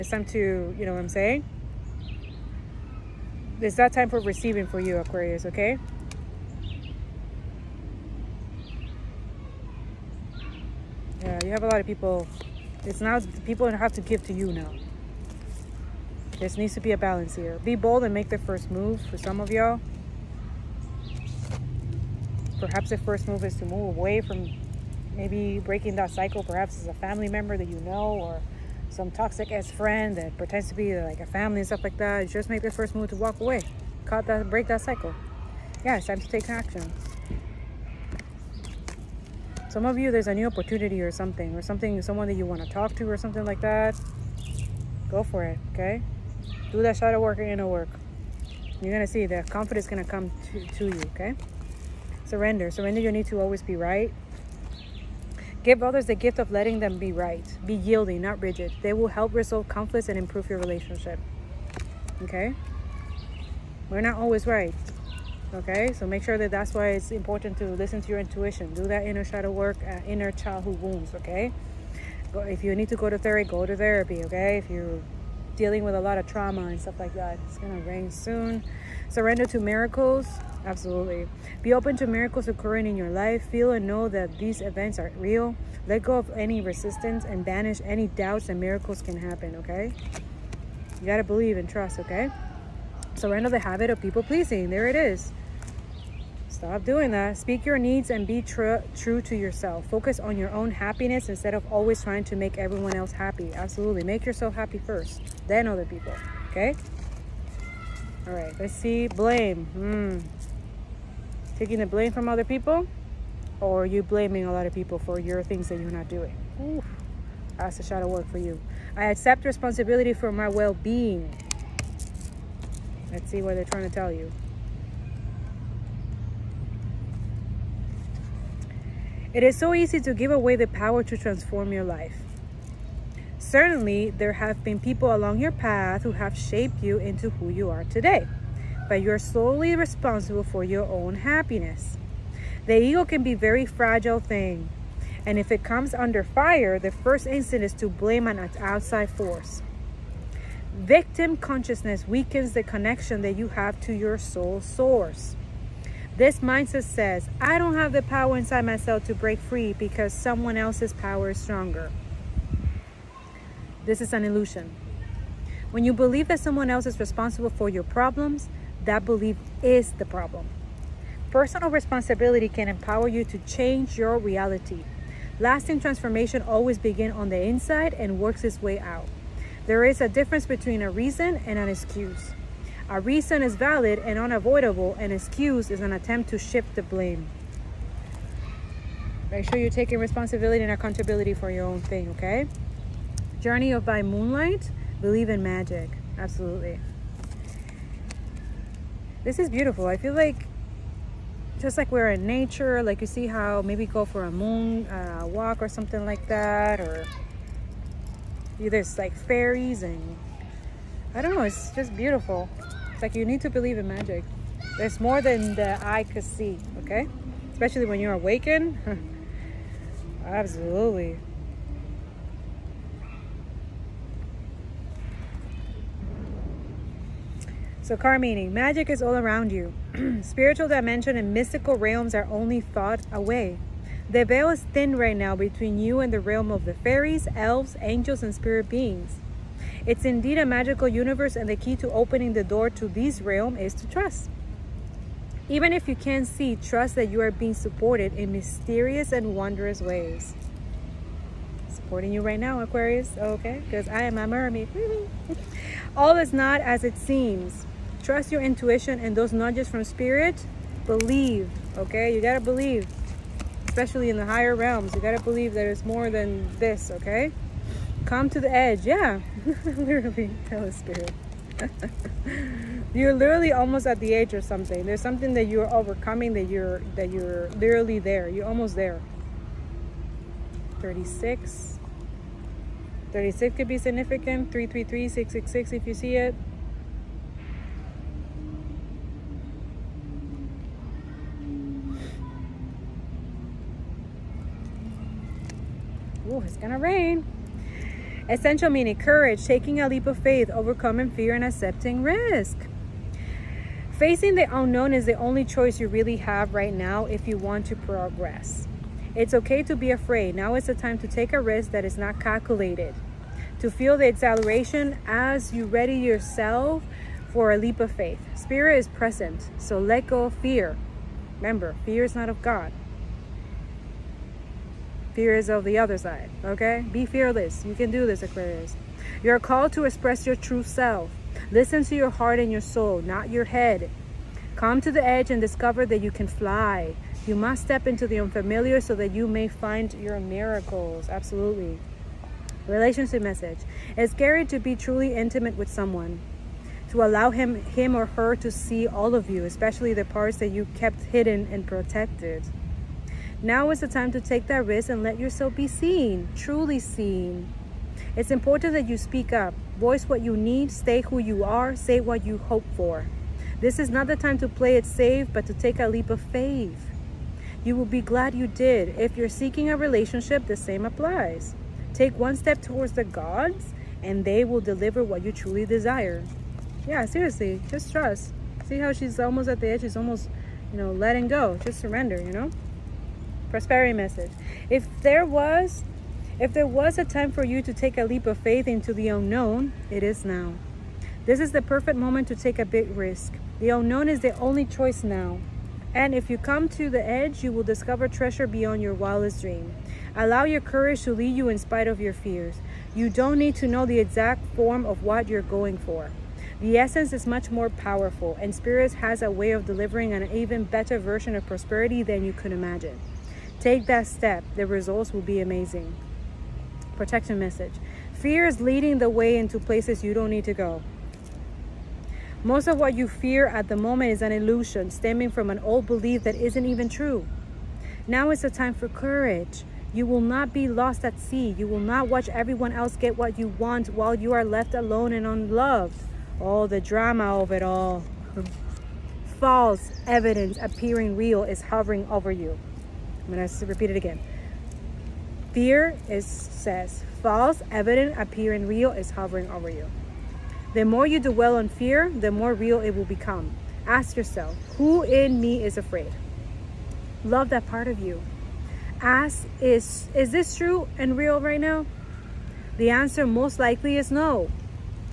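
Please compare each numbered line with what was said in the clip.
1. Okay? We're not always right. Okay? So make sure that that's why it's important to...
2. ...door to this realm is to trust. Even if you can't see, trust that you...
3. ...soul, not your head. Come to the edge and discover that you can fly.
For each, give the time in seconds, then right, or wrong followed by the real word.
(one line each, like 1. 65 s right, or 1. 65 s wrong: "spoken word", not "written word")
1. 62 s right
2. 242 s right
3. 332 s right.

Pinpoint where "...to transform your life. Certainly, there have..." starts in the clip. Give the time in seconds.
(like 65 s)
131 s.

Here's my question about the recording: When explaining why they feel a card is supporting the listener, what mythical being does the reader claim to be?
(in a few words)
a mermaid.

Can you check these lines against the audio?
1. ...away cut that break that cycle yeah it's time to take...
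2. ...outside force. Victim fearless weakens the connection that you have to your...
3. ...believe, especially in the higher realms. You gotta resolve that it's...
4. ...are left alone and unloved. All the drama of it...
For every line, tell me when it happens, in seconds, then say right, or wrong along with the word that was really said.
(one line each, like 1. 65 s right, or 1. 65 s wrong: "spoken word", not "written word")
1. 33 s right
2. 148 s wrong: "consciousness", not "fearless"
3. 262 s wrong: "believe", not "resolve"
4. 434 s right.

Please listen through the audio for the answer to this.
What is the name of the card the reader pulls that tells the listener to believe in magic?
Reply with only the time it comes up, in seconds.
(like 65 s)
193 s.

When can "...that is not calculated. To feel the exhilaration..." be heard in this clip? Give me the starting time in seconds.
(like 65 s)
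311 s.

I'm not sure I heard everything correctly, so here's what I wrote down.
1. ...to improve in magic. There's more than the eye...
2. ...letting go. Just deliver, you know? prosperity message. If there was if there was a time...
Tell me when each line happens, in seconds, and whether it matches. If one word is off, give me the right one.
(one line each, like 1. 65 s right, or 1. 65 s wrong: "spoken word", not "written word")
1. 213 s wrong: "believe", not "improve"
2. 380 s wrong: "surrender", not "deliver".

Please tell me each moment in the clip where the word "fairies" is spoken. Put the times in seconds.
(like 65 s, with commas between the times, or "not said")
209 s, 236 s.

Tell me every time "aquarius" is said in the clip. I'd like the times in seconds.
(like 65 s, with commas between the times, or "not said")
4 s, 252 s, 328 s.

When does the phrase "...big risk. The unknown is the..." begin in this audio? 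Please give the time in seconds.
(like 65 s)
392 s.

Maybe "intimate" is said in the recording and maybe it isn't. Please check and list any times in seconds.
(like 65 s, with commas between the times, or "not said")
345 s.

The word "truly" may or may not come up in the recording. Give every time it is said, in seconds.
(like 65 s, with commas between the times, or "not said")
344 s, 356 s, 375 s.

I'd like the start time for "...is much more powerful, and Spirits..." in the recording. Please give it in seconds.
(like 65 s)
407 s.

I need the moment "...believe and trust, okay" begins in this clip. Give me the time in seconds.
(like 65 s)
91 s.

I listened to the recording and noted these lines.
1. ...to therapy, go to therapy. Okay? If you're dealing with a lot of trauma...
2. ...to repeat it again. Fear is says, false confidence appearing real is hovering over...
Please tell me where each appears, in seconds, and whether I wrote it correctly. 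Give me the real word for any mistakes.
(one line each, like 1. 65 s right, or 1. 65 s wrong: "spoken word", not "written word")
1. 73 s right
2. 443 s wrong: "evidence", not "confidence".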